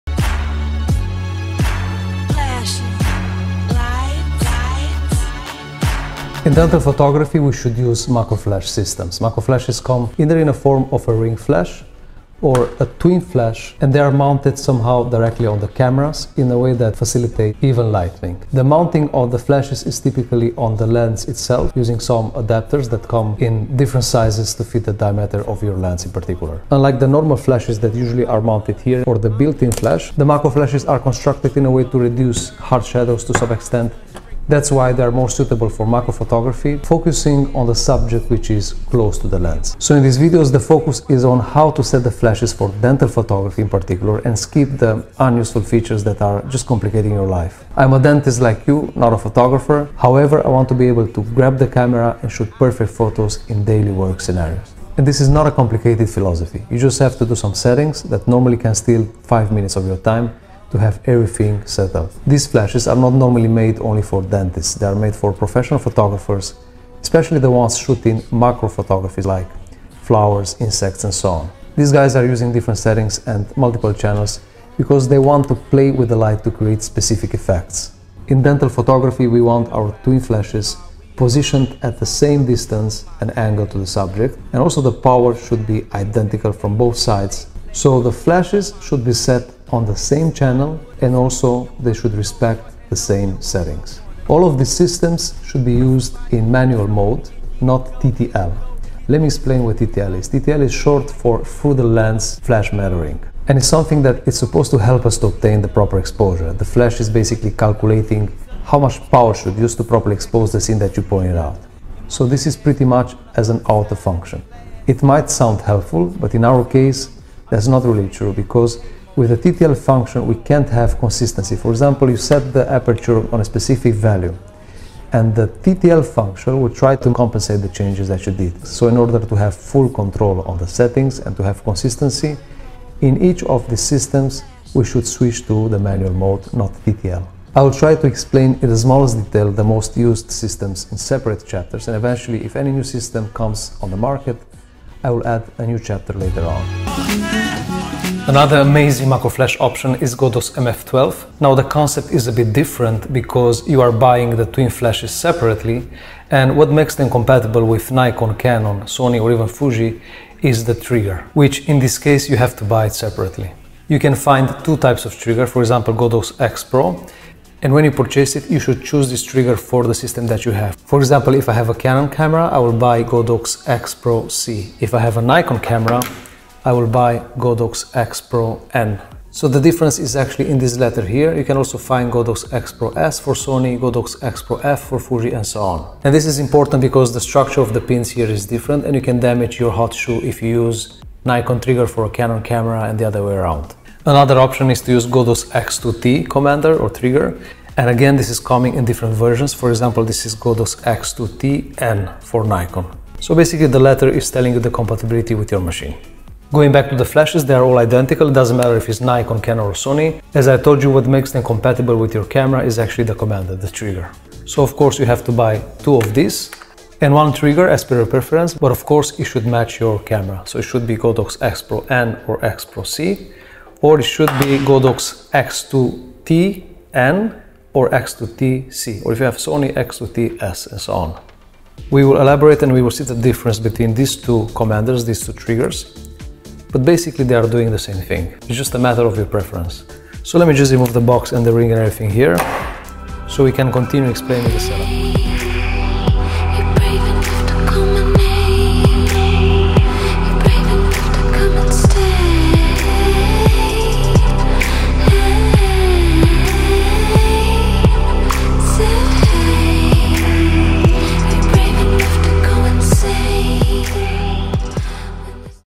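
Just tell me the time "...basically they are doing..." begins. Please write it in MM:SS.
03:56.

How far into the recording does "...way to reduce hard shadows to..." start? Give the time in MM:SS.
00:31.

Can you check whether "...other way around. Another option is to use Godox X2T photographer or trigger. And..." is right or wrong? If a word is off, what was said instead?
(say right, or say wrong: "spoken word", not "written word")
wrong: "commander", not "photographer".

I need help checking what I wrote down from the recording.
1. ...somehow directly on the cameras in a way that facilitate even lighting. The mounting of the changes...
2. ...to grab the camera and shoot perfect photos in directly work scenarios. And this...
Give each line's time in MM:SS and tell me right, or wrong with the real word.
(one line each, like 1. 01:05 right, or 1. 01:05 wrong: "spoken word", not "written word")
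1. 00:14 wrong: "flashes", not "changes"
2. 00:51 wrong: "daily", not "directly".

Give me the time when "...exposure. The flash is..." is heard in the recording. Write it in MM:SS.
01:45.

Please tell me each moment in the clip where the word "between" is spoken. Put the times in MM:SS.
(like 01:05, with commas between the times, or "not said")
03:53.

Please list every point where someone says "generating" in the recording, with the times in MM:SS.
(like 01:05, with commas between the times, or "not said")
not said.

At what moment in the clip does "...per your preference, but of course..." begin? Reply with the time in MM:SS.
03:37.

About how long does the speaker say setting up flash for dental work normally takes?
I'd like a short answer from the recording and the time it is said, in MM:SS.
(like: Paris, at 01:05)
5 minutes, at 00:59.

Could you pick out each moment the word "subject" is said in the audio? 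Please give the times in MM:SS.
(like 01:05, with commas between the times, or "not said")
00:37, 01:23.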